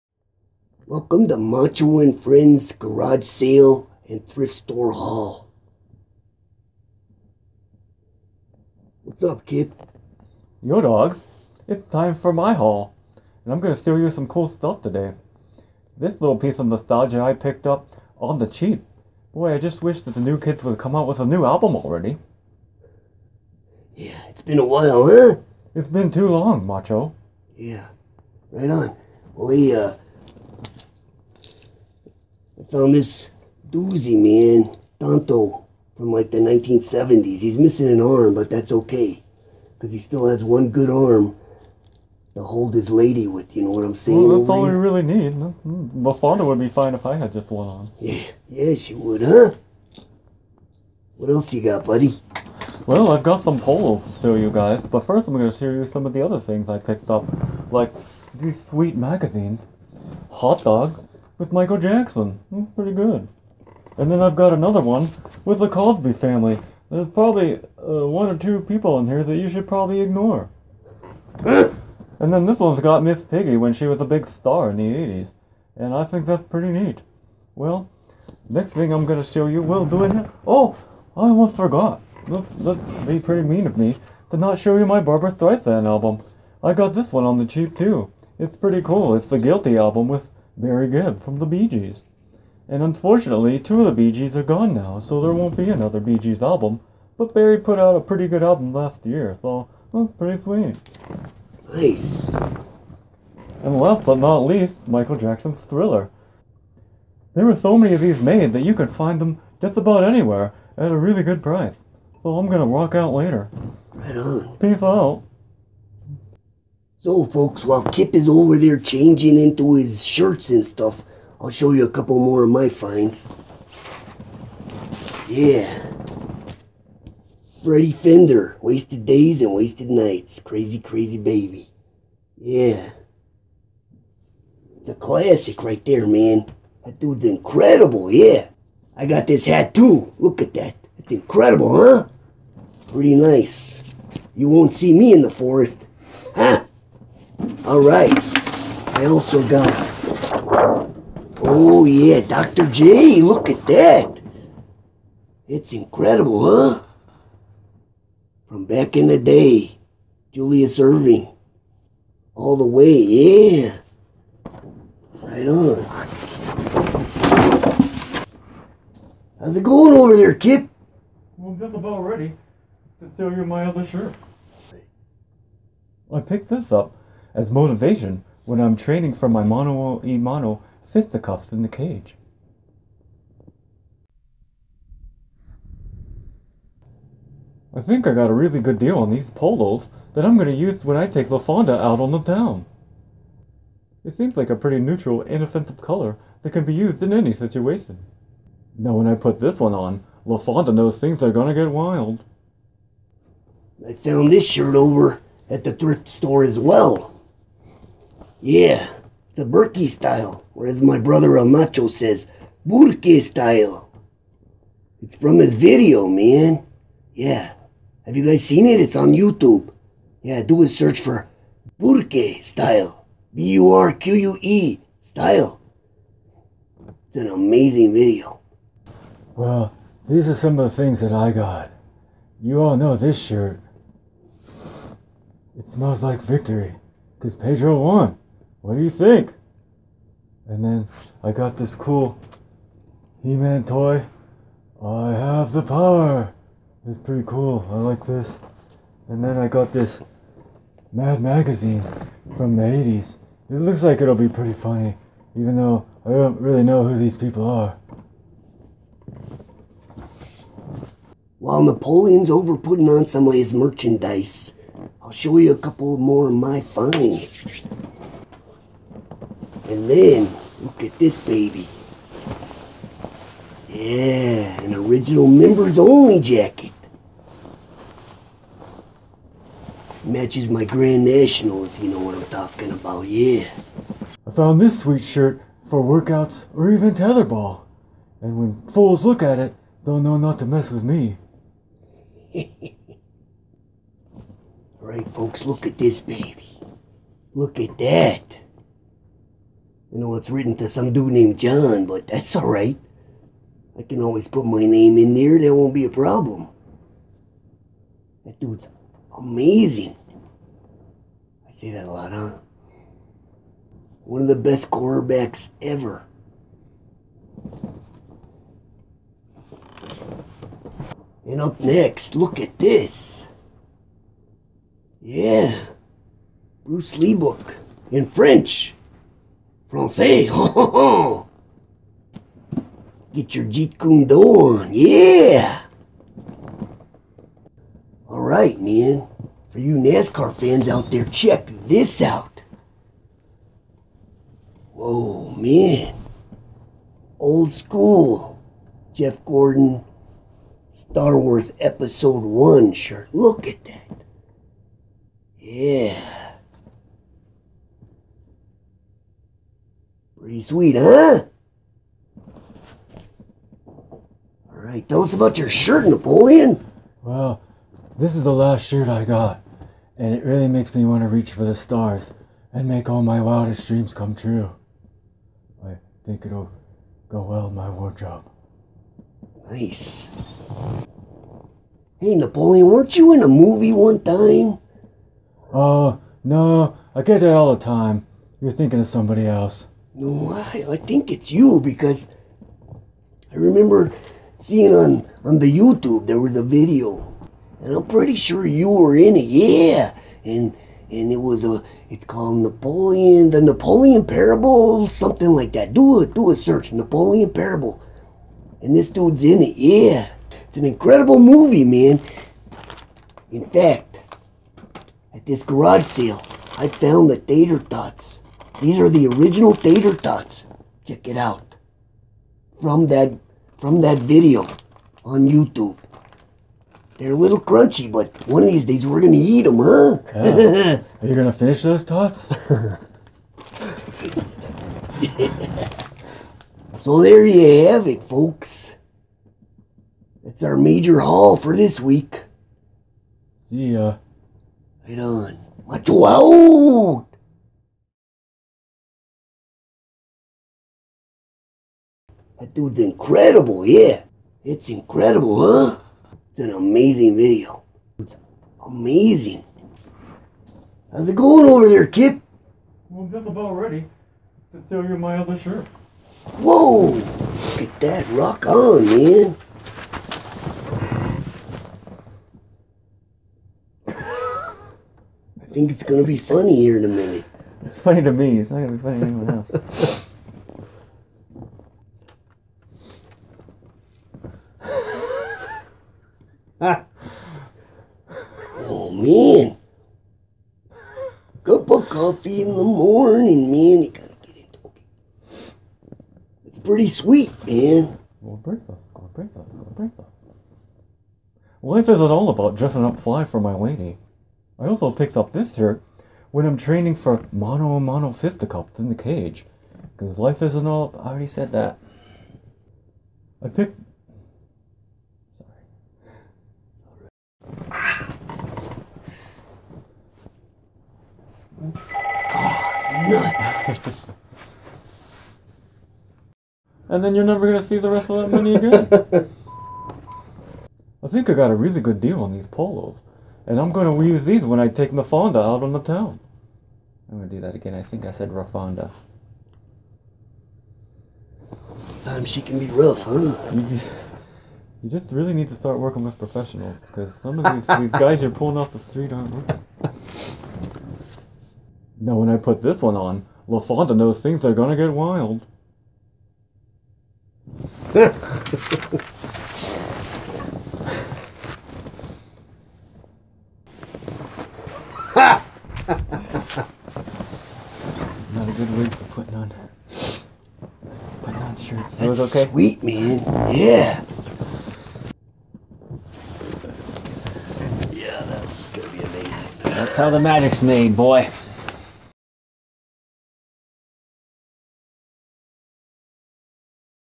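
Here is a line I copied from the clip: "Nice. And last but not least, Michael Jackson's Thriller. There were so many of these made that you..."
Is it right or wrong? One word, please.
right.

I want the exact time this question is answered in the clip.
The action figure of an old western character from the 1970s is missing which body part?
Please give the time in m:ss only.
0:37.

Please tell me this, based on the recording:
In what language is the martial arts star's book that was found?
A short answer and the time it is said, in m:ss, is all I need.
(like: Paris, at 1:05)
French, at 5:28.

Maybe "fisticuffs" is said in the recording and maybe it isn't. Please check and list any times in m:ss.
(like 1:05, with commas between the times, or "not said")
3:00, 8:28.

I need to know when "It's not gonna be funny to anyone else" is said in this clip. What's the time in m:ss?
7:58.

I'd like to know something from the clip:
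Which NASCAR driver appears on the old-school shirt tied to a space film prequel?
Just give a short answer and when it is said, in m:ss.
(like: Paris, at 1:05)
Jeff Gordon, at 5:48.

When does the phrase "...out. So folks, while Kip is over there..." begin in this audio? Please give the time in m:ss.
1:54.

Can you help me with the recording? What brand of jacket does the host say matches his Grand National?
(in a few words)
Members Only.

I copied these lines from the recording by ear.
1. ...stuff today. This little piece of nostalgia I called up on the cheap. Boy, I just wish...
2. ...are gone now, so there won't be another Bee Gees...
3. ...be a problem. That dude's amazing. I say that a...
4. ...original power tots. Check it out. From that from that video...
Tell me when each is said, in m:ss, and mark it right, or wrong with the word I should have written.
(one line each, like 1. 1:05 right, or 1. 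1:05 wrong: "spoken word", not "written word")
1. 0:14 wrong: "picked", not "called"
2. 1:34 right
3. 5:05 right
4. 6:59 wrong: "tater", not "power".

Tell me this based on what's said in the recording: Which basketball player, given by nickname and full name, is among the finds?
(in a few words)
Julius Erving.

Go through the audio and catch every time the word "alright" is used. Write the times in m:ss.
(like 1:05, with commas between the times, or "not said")
4:54, 5:02, 5:38, 6:04.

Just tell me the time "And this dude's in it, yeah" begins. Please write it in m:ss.
6:48.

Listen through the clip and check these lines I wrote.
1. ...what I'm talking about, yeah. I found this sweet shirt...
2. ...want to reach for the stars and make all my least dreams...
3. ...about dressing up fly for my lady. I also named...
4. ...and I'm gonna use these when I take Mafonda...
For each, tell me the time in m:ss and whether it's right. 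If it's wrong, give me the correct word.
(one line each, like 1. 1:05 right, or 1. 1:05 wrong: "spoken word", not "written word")
1. 4:41 right
2. 6:10 wrong: "wildest", not "least"
3. 8:22 wrong: "picked", not "named"
4. 8:53 right.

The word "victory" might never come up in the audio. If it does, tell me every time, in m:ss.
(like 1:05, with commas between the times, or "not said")
3:56.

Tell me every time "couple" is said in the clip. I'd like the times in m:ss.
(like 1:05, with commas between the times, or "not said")
2:01, 4:25.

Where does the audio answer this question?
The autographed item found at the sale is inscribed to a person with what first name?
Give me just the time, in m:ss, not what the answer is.
5:01.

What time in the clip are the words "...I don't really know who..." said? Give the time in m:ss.
4:16.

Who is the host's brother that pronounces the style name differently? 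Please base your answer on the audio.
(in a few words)
El Nacho.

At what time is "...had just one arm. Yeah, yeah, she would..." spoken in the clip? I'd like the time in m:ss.
0:47.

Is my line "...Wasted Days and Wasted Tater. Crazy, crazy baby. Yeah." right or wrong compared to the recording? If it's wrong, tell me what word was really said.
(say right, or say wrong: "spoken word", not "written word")
wrong: "Nights", not "Tater".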